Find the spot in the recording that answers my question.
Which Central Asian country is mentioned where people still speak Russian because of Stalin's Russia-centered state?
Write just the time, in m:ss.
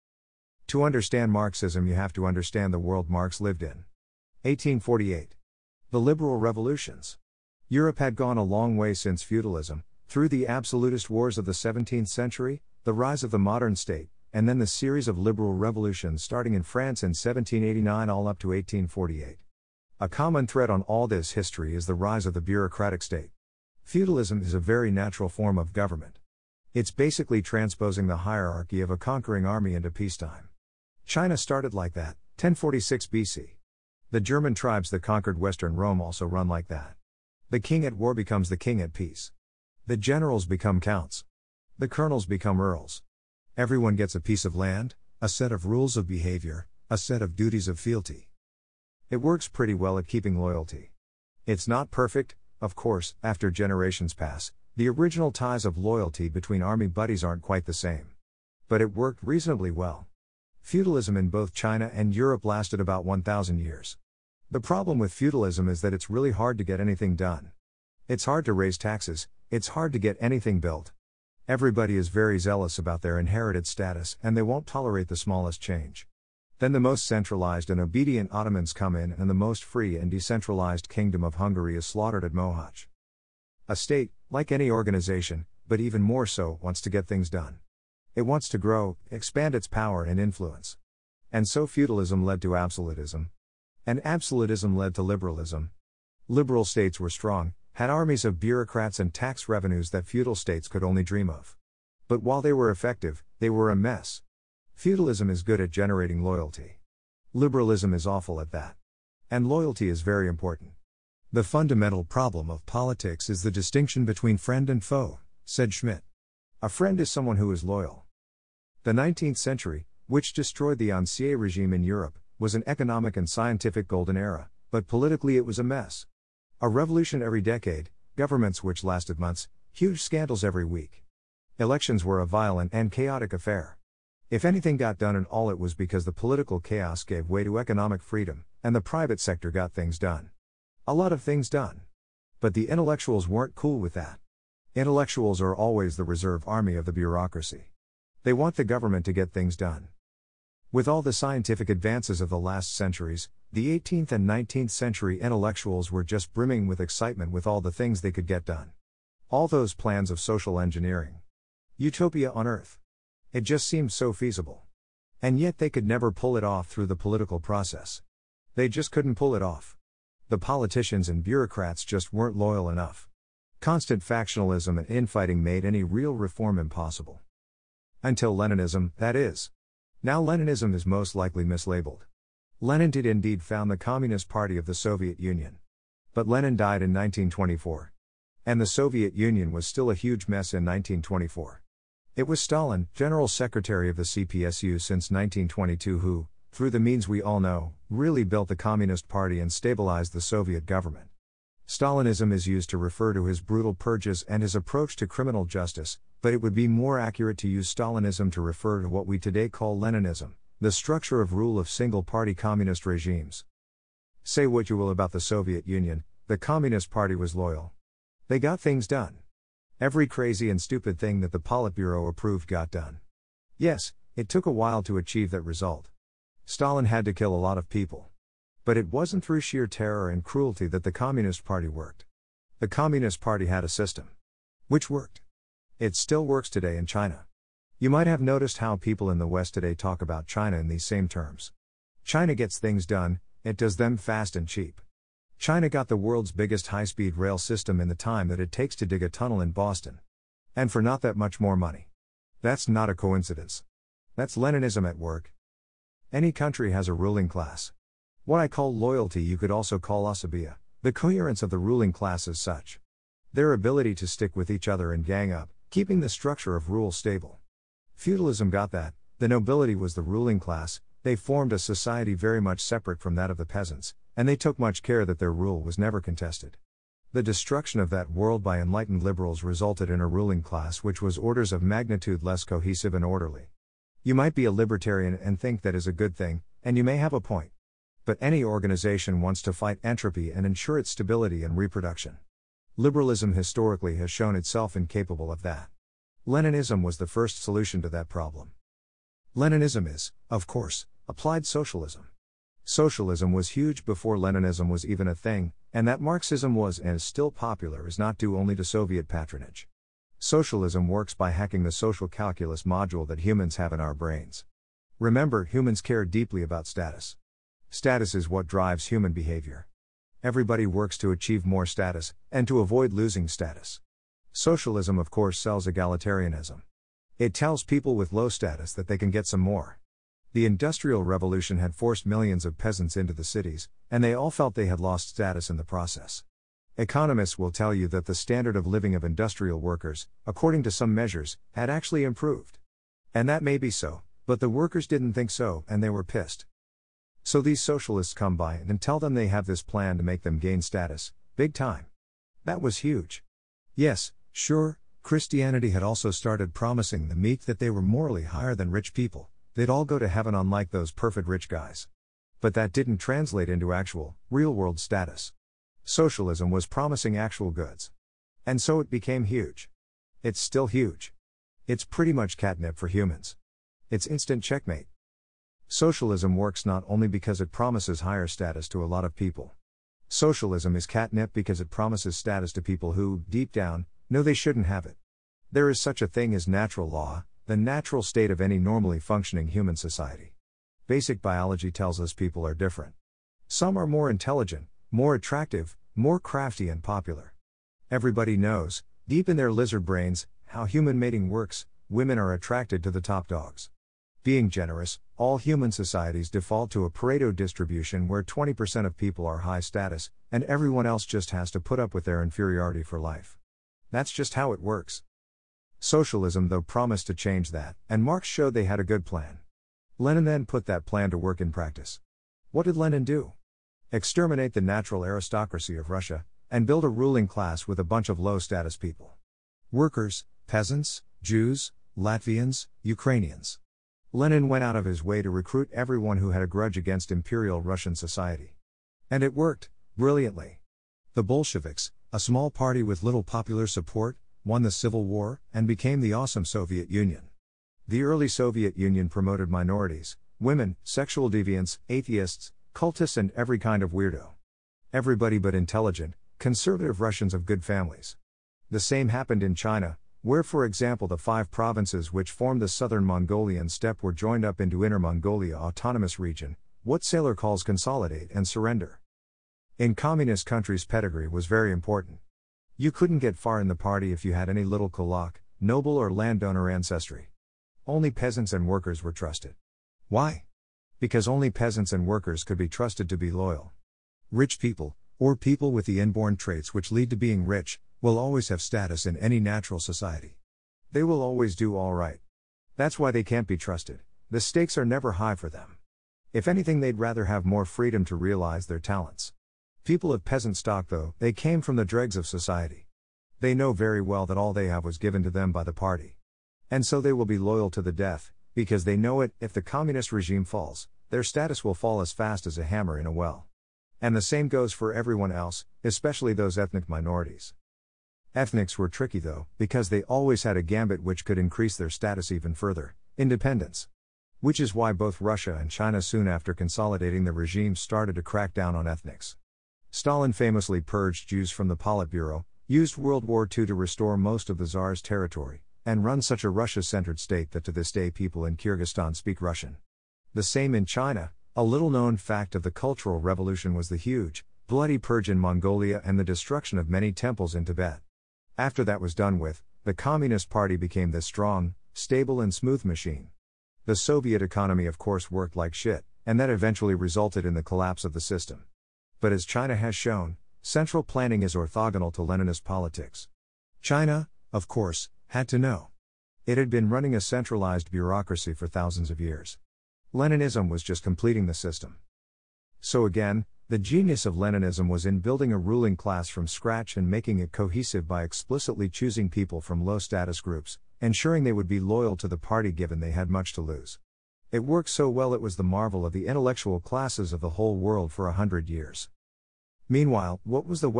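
8:58.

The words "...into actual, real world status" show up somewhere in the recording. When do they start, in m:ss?
6:03.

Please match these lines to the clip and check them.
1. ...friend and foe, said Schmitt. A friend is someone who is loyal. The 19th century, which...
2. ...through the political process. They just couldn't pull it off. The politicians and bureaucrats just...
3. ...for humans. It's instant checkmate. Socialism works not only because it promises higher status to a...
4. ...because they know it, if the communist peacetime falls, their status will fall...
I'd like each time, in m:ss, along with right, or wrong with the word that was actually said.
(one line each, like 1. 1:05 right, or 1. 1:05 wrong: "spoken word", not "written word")
1. 1:54 right
2. 2:46 right
3. 6:12 right
4. 8:28 wrong: "regime", not "peacetime".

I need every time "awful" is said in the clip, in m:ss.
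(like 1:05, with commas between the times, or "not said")
1:48.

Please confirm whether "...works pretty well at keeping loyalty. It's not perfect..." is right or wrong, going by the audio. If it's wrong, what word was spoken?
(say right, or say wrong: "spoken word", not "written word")
right.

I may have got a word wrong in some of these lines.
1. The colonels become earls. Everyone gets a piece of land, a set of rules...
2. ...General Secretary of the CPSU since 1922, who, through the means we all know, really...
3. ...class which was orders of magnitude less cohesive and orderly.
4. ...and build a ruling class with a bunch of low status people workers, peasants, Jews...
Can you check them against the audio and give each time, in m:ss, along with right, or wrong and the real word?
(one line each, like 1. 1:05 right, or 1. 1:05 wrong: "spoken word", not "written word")
1. 0:41 right
2. 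3:12 right
3. 4:40 right
4. 7:06 right.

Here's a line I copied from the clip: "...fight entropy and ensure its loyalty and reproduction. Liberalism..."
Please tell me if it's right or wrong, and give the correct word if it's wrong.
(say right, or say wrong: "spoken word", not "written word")
wrong: "stability", not "loyalty".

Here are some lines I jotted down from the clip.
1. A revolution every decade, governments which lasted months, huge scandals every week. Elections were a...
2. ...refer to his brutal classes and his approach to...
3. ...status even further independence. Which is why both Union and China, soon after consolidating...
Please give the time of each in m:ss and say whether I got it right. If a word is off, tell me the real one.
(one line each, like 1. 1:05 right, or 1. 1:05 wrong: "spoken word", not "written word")
1. 2:06 right
2. 3:22 wrong: "purges", not "classes"
3. 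8:41 wrong: "Russia", not "Union".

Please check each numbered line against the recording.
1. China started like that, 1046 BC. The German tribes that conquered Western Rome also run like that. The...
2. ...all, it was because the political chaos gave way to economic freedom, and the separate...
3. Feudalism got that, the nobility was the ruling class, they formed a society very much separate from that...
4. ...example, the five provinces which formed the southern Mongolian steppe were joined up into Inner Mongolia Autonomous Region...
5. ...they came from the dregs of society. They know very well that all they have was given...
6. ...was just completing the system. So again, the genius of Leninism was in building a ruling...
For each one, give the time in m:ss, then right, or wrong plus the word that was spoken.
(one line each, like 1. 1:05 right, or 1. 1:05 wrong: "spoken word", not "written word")
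1. 0:31 right
2. 2:15 wrong: "private", not "separate"
3. 4:27 right
4. 7:40 right
5. 8:21 right
6. 9:30 right.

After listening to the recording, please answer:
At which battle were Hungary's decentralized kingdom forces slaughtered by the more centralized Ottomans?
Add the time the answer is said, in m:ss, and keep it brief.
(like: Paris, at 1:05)
Mohacs, at 1:22.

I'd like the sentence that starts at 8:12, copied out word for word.
That's why they can't be trusted.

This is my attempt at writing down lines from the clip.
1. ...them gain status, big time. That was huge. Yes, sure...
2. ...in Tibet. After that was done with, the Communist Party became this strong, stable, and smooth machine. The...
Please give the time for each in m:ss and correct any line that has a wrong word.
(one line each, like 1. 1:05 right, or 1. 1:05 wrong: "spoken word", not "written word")
1. 5:50 right
2. 9:07 right.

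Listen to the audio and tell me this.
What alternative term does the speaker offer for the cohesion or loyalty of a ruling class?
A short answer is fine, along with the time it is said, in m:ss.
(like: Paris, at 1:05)
asabia, at 4:20.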